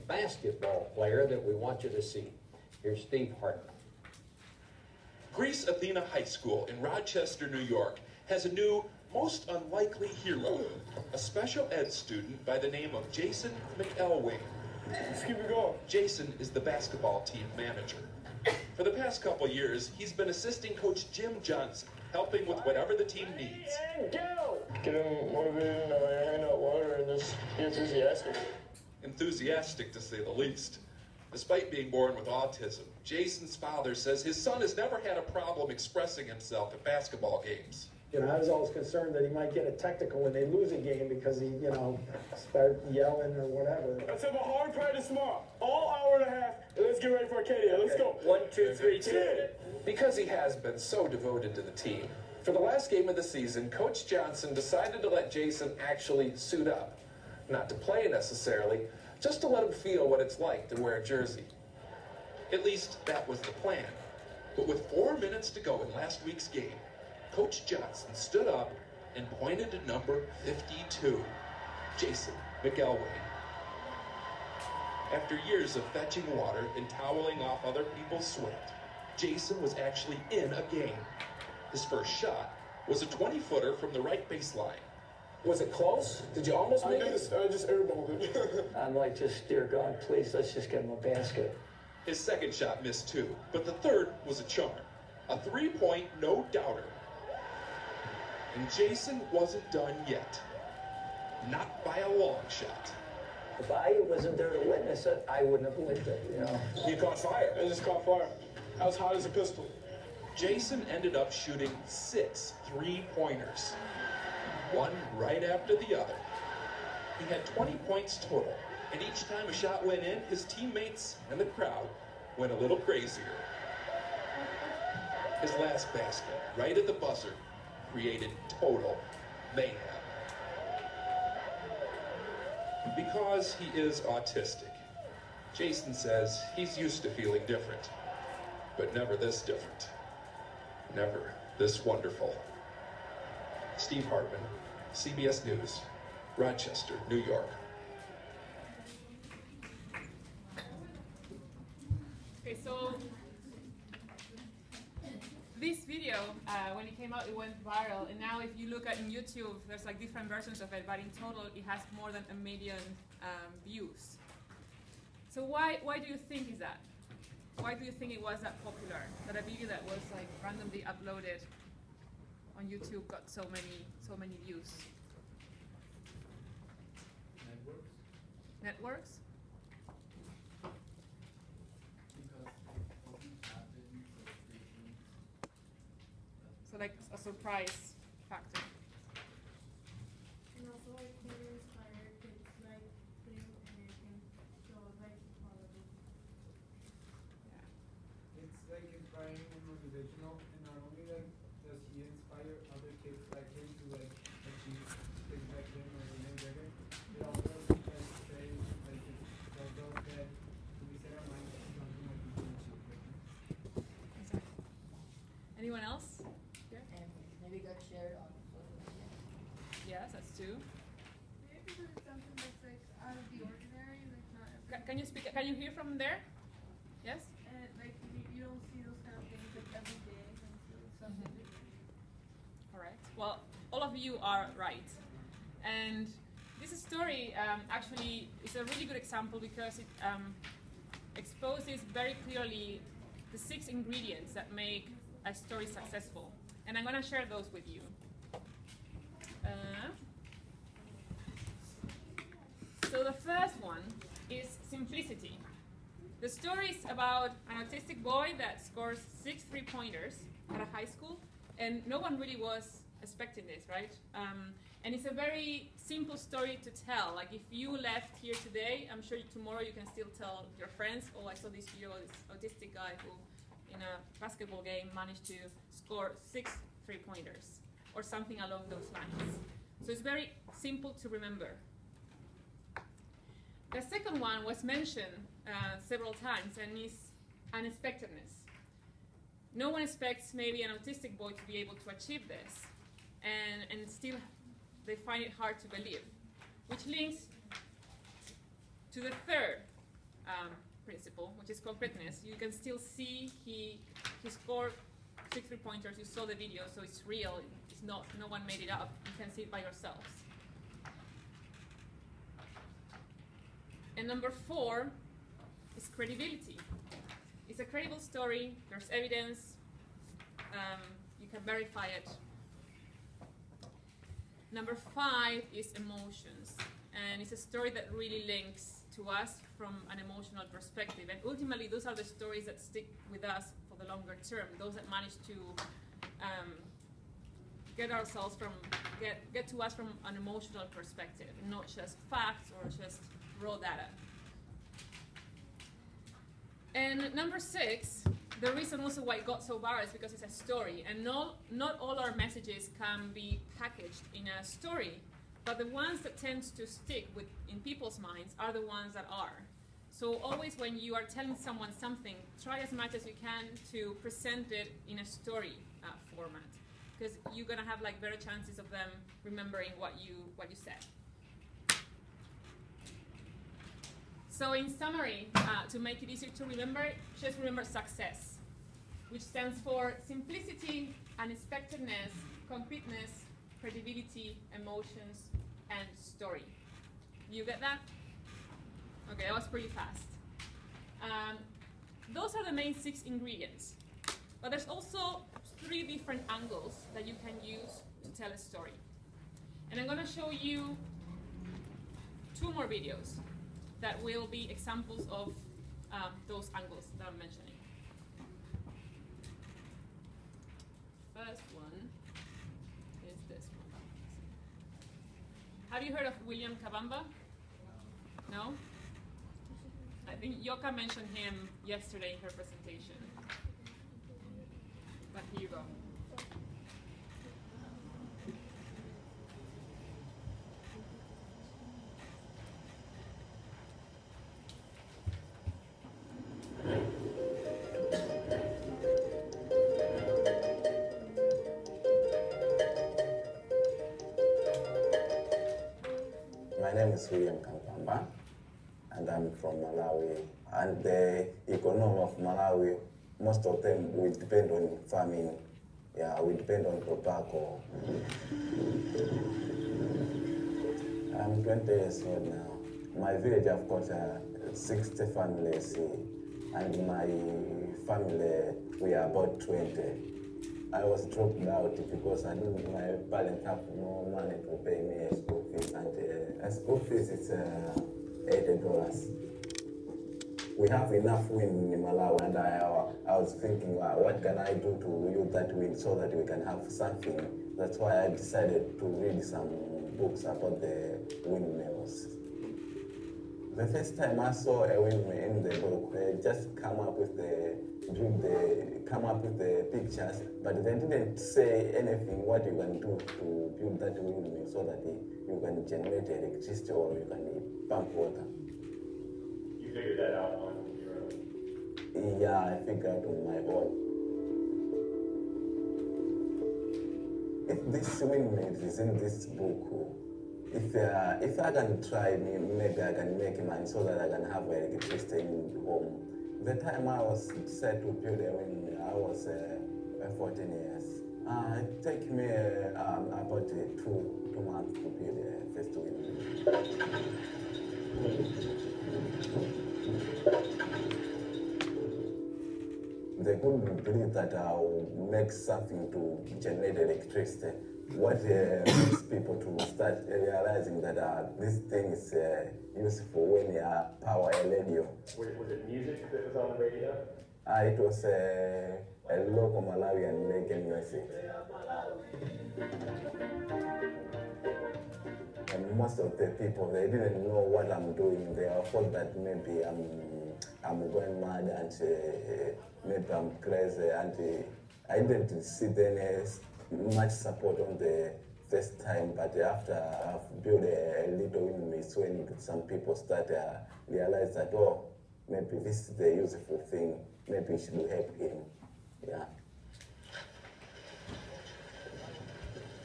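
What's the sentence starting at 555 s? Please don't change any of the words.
Was it, music that was on the radio?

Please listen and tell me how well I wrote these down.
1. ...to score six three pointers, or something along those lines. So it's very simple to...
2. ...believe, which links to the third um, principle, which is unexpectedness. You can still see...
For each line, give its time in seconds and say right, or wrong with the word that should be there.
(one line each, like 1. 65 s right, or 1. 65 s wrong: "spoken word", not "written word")
1. 275 s right
2. 295 s wrong: "concreteness", not "unexpectedness".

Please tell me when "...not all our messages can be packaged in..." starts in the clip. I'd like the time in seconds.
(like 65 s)
351 s.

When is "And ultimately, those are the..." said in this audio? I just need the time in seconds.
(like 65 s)
331 s.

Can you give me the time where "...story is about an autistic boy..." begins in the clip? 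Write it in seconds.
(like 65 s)
256 s.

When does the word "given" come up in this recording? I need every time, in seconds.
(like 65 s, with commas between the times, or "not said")
not said.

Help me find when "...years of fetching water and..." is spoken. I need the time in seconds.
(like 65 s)
75 s.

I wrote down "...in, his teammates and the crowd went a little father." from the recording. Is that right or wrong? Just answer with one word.
wrong.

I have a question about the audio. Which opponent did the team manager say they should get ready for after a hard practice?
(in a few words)
Arcadia.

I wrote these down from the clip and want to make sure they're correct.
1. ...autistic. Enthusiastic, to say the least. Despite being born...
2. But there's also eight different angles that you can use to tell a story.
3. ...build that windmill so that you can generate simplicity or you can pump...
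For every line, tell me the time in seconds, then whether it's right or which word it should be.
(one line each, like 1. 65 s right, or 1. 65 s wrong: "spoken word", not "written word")
1. 27 s wrong: "enthusiastic", not "autistic"
2. 394 s wrong: "three", not "eight"
3. 503 s wrong: "electricity", not "simplicity".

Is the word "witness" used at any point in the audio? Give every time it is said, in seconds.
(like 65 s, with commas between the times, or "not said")
104 s.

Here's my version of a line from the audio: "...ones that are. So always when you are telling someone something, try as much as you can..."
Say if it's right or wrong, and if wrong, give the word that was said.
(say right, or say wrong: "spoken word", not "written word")
right.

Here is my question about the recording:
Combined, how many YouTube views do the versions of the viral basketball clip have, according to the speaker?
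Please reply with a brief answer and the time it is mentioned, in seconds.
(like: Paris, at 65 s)
a million, at 162 s.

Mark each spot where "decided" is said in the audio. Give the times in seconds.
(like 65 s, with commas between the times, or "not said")
54 s, 488 s.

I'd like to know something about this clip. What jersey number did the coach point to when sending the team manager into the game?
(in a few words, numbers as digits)
52.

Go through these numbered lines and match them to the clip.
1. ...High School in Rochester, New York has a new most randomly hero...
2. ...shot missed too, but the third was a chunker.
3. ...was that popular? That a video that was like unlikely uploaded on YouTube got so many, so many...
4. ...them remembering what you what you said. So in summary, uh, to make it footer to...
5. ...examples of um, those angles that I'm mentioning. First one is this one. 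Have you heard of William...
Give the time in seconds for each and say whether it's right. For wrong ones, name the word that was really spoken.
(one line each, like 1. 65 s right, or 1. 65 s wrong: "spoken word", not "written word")
1. 6 s wrong: "unlikely", not "randomly"
2. 92 s right
3. 168 s wrong: "randomly", not "unlikely"
4. 368 s wrong: "easier", not "footer"
5. 404 s right.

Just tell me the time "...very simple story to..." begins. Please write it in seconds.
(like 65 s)
265 s.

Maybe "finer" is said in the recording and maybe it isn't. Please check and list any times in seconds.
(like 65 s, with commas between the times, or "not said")
not said.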